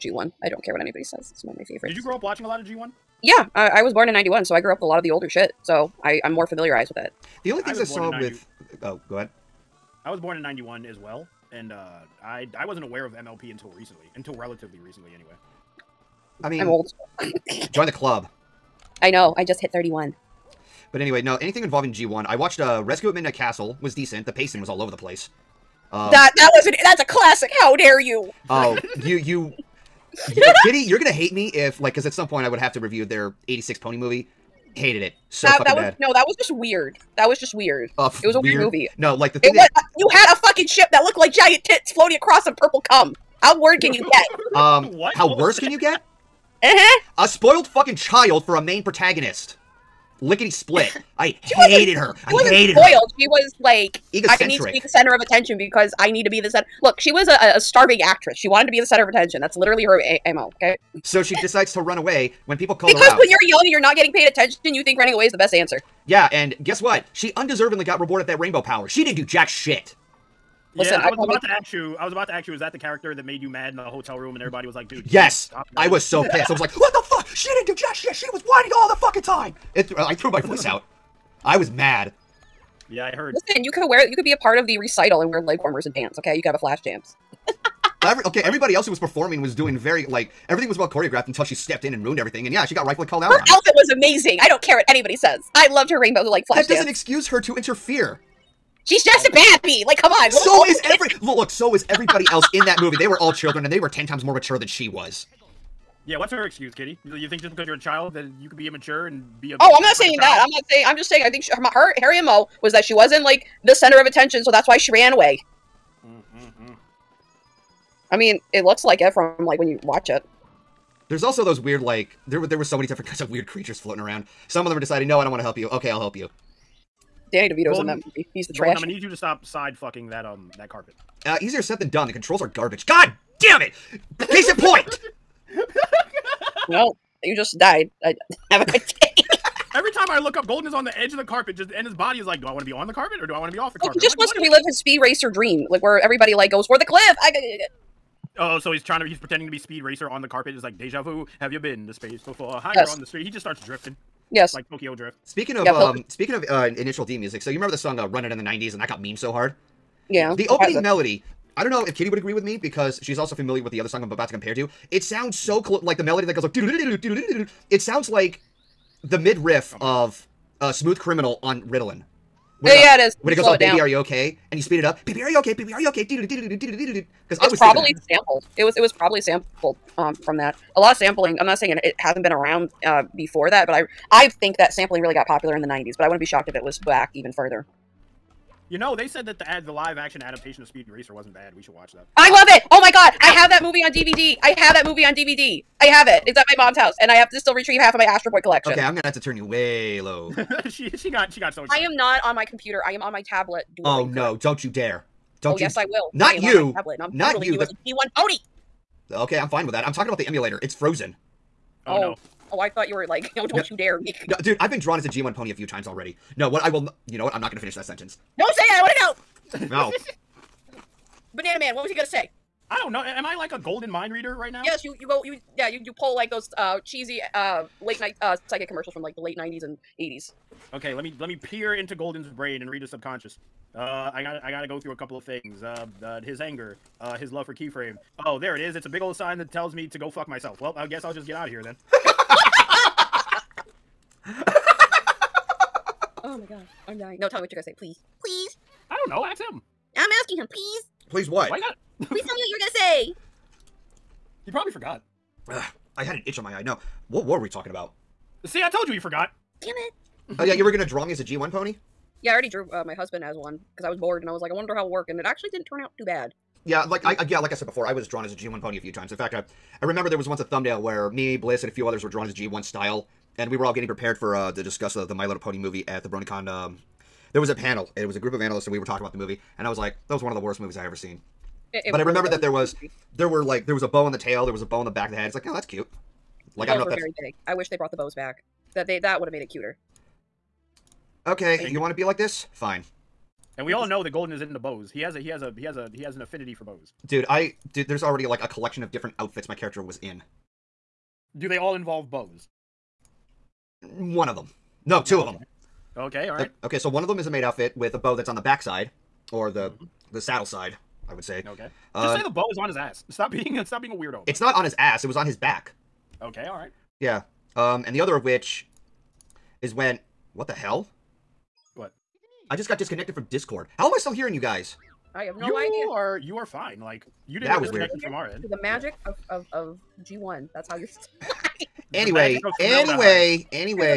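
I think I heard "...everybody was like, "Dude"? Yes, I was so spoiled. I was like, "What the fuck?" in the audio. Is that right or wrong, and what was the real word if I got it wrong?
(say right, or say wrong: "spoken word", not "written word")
wrong: "pissed", not "spoiled".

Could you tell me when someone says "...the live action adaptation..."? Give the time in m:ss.
3:09.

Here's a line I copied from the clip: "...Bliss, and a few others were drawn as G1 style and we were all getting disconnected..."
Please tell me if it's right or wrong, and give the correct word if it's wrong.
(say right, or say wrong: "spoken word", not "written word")
wrong: "prepared", not "disconnected".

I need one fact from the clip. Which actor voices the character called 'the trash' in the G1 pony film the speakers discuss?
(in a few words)
Danny DeVito.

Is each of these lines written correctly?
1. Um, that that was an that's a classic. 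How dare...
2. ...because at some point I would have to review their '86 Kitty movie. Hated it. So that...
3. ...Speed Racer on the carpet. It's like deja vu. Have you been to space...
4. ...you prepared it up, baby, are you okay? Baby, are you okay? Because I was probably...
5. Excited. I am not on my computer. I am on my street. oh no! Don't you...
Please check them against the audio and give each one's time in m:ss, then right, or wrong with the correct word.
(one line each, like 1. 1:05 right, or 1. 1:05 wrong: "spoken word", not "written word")
1. 0:25 right
2. 0:31 wrong: "Pony", not "Kitty"
3. 2:29 right
4. 2:54 wrong: "speed", not "prepared"
5. 3:21 wrong: "tablet", not "street".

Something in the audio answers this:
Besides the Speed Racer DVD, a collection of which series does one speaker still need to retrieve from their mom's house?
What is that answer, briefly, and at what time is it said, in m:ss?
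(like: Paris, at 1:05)
Astro Boy, at 3:18.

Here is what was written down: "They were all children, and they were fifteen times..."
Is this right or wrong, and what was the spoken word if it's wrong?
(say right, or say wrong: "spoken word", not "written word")
wrong: "ten", not "fifteen".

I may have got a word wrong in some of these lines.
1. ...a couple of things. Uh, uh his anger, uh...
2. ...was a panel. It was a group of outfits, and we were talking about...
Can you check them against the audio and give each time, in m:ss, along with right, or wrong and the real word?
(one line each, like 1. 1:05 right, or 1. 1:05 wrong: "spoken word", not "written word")
1. 3:54 right
2. 4:37 wrong: "analysts", not "outfits".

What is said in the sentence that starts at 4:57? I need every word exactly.
Dude, I dude, there's already like a collection of different outfits my character was in.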